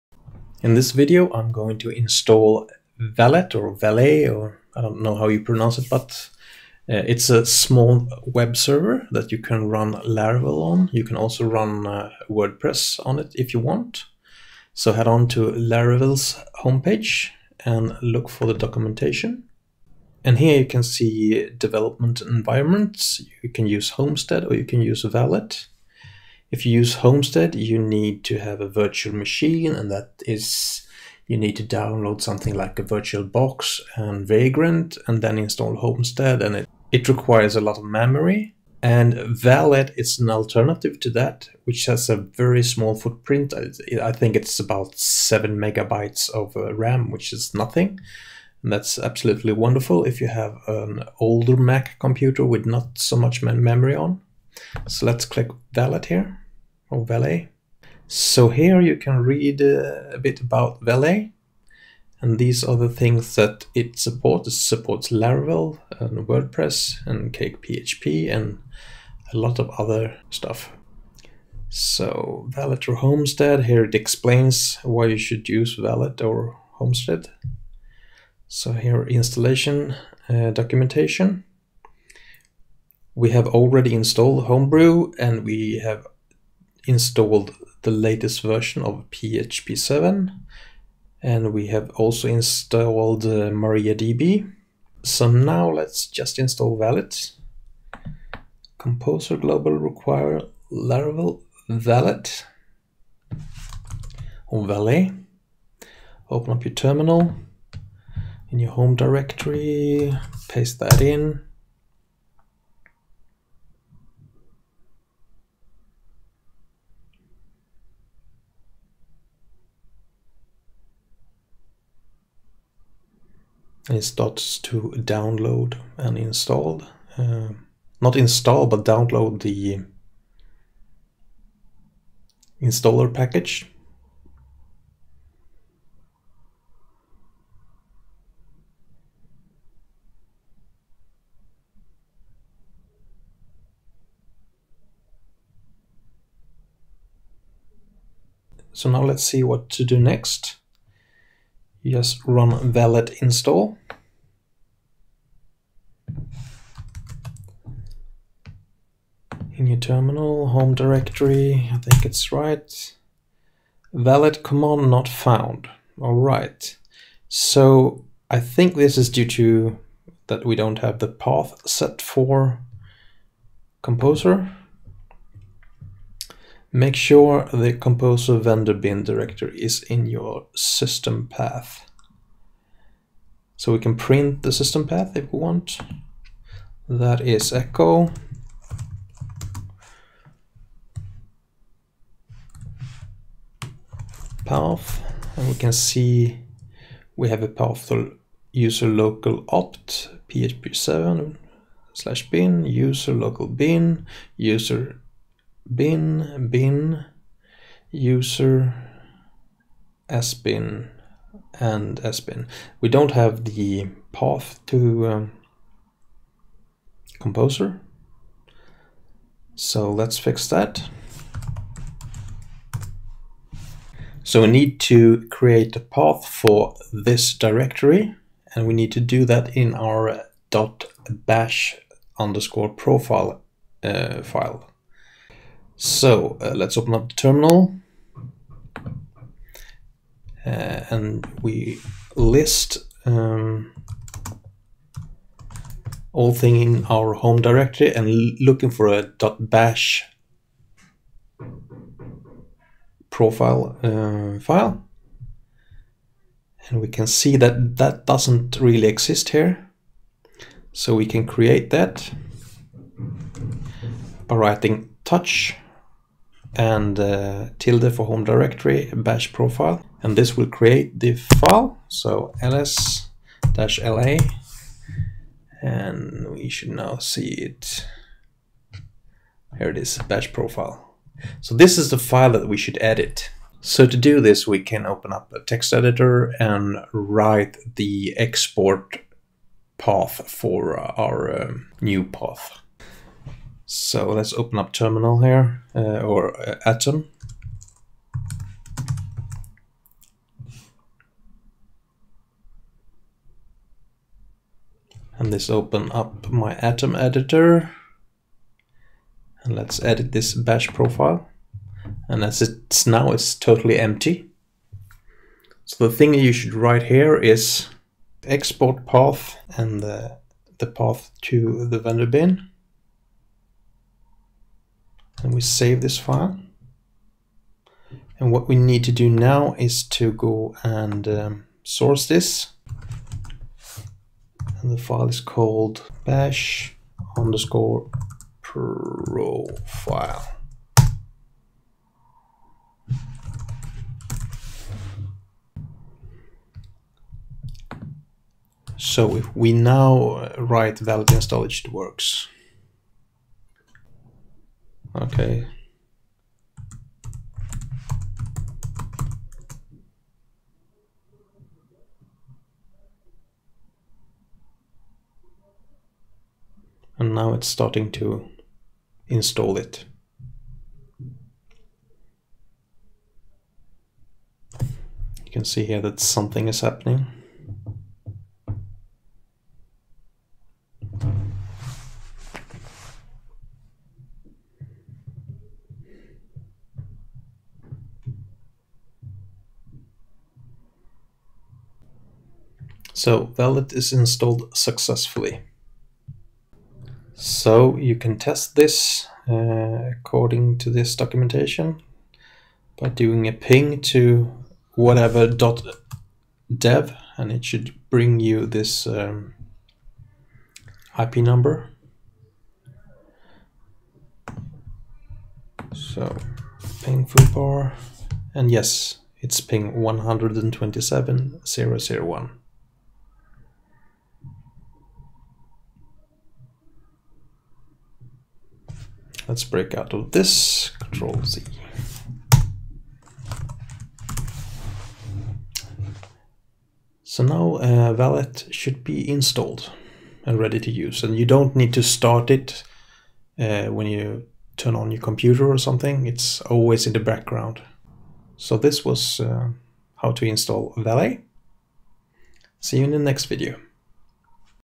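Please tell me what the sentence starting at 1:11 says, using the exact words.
So Valet or Homestead, here it explains why you should use Valet or Homestead.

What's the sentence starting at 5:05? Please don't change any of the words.
And let's open up my Atom editor.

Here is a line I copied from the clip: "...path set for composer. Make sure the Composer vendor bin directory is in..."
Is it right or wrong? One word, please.
right.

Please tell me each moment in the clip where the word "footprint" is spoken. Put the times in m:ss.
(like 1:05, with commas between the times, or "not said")
0:42.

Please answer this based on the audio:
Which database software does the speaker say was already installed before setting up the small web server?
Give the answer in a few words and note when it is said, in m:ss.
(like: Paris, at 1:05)
MariaDB, at 1:33.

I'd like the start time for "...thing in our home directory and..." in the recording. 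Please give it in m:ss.
4:06.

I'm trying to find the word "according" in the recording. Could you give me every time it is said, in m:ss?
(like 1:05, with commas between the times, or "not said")
6:39.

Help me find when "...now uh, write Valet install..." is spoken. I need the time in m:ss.
5:49.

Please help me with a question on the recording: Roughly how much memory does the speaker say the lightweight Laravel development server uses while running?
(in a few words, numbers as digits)
7 megabytes.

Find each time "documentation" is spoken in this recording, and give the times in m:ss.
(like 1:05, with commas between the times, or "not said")
0:18, 1:20, 6:40.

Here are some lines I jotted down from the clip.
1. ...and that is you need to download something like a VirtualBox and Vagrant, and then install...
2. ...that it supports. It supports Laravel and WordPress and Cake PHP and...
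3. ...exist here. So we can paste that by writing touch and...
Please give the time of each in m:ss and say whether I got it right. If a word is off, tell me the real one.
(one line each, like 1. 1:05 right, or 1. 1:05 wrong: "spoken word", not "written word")
1. 0:29 right
2. 1:03 right
3. 4:18 wrong: "create", not "paste".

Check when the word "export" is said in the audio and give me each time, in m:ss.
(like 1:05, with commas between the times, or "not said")
4:48, 5:18.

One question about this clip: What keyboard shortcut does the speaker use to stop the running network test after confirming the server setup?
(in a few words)
Control Z.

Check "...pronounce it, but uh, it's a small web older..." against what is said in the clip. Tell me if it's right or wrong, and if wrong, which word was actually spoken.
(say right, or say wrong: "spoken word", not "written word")
wrong: "server", not "older".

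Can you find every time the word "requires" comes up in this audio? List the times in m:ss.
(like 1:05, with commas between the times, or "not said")
0:37, 1:39.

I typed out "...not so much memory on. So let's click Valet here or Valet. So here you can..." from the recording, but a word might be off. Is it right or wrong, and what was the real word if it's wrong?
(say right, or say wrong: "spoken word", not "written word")
right.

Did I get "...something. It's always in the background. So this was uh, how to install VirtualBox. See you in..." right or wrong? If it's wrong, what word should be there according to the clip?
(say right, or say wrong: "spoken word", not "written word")
wrong: "Valet", not "VirtualBox".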